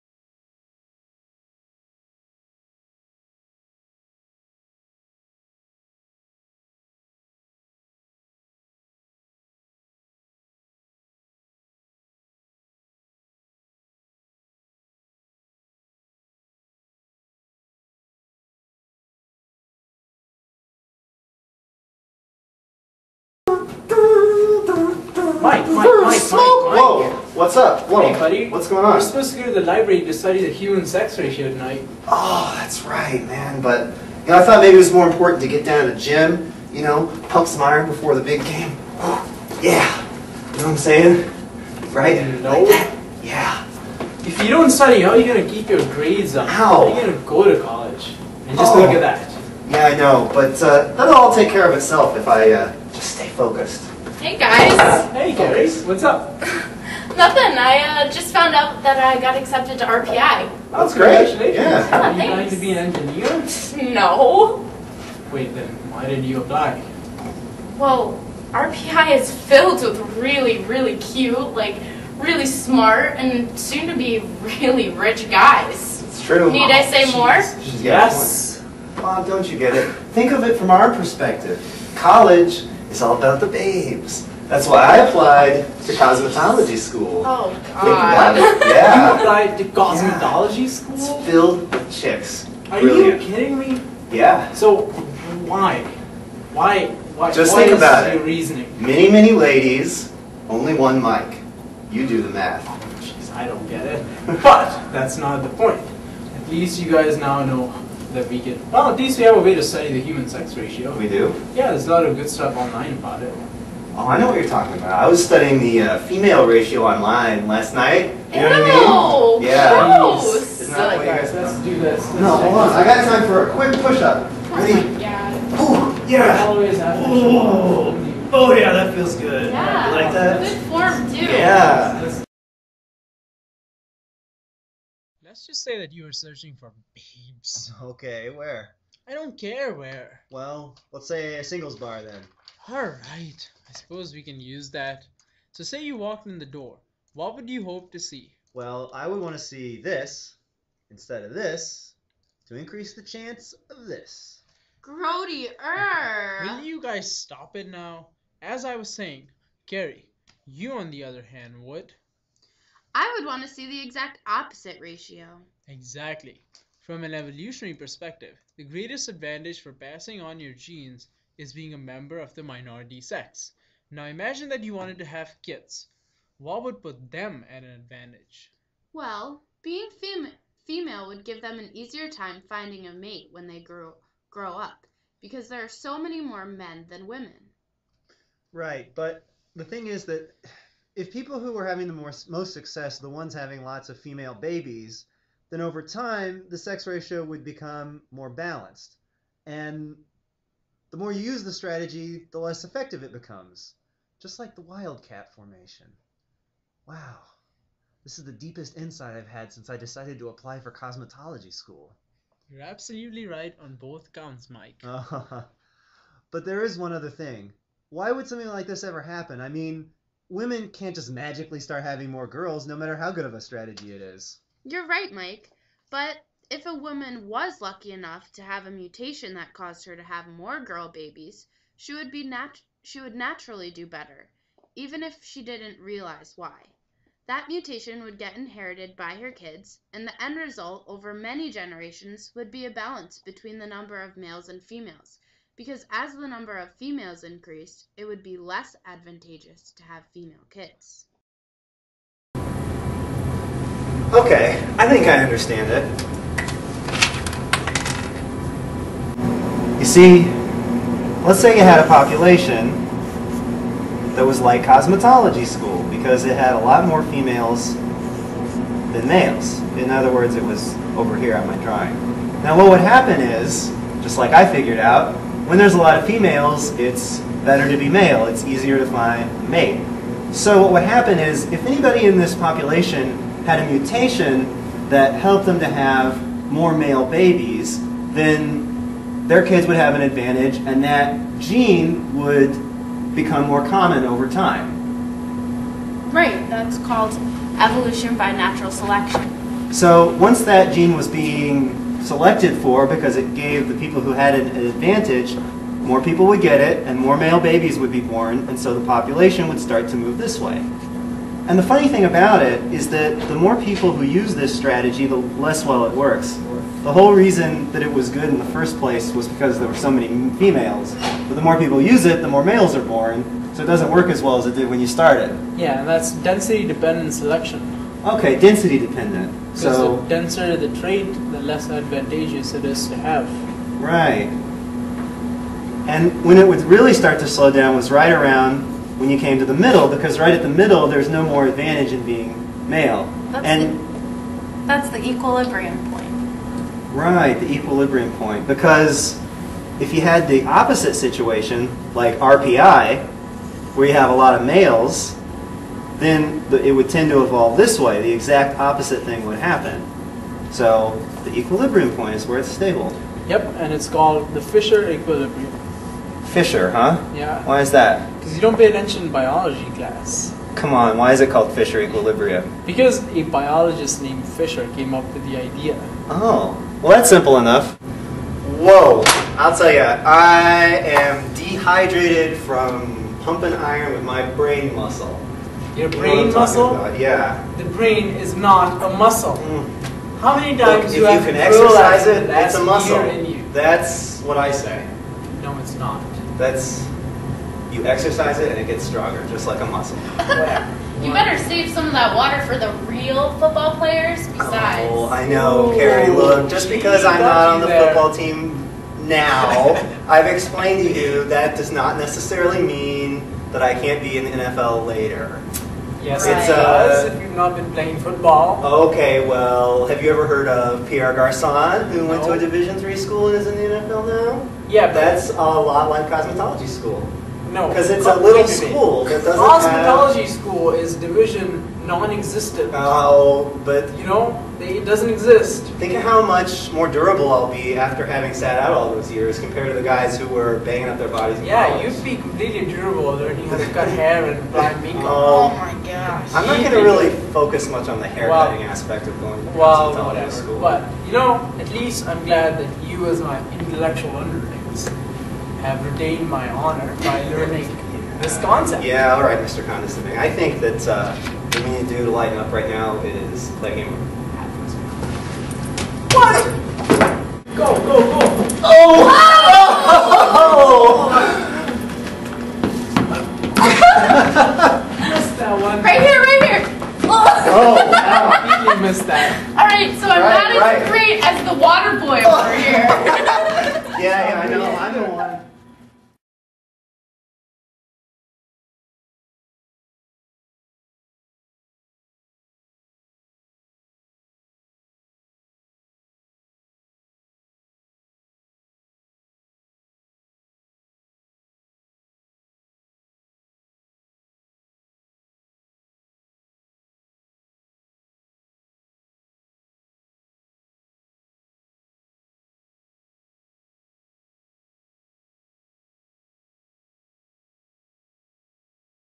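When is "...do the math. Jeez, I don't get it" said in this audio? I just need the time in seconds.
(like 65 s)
102 s.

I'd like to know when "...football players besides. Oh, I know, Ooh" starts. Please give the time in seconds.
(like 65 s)
403 s.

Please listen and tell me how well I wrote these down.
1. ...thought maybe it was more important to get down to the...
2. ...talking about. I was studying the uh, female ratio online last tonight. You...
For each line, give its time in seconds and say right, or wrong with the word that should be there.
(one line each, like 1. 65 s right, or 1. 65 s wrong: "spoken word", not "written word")
1. 34 s right
2. 114 s wrong: "night", not "tonight".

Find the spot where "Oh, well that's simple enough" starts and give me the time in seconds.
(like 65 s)
376 s.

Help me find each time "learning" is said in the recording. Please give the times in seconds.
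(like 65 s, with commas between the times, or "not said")
443 s, 457 s.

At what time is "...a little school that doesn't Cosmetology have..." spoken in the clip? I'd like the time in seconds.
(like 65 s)
428 s.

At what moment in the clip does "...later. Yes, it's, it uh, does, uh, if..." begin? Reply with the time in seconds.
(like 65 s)
414 s.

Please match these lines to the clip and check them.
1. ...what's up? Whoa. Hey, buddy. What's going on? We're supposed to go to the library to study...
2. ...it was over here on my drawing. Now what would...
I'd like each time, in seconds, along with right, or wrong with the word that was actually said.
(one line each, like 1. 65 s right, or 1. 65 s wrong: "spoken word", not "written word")
1. 27 s right
2. 270 s right.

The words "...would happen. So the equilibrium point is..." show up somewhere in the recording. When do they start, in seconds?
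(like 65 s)
359 s.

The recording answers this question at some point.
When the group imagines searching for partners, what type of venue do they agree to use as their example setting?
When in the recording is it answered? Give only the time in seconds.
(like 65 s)
141 s.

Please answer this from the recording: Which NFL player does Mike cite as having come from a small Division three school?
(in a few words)
Pierre Garcon.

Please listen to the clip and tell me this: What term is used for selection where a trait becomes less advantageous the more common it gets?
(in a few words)
Density-dependent selection.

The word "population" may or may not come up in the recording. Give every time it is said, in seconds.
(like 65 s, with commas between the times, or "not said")
261 s, 282 s, 308 s.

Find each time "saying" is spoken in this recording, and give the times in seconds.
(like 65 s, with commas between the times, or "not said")
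40 s, 158 s.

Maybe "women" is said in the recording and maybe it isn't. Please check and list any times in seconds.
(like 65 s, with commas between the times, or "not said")
187 s, 220 s.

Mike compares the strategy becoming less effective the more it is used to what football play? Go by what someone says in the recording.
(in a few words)
The wildcat formation.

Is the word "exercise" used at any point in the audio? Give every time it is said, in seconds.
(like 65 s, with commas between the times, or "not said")
391 s, 397 s.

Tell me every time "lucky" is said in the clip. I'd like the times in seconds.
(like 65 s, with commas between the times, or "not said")
227 s.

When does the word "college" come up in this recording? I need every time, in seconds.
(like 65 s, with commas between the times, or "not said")
47 s, 81 s, 441 s.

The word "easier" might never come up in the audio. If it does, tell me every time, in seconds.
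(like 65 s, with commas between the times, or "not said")
181 s, 278 s.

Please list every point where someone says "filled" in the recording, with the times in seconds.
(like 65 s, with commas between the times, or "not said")
69 s, 91 s.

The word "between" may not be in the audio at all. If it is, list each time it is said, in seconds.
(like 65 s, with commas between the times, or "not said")
243 s.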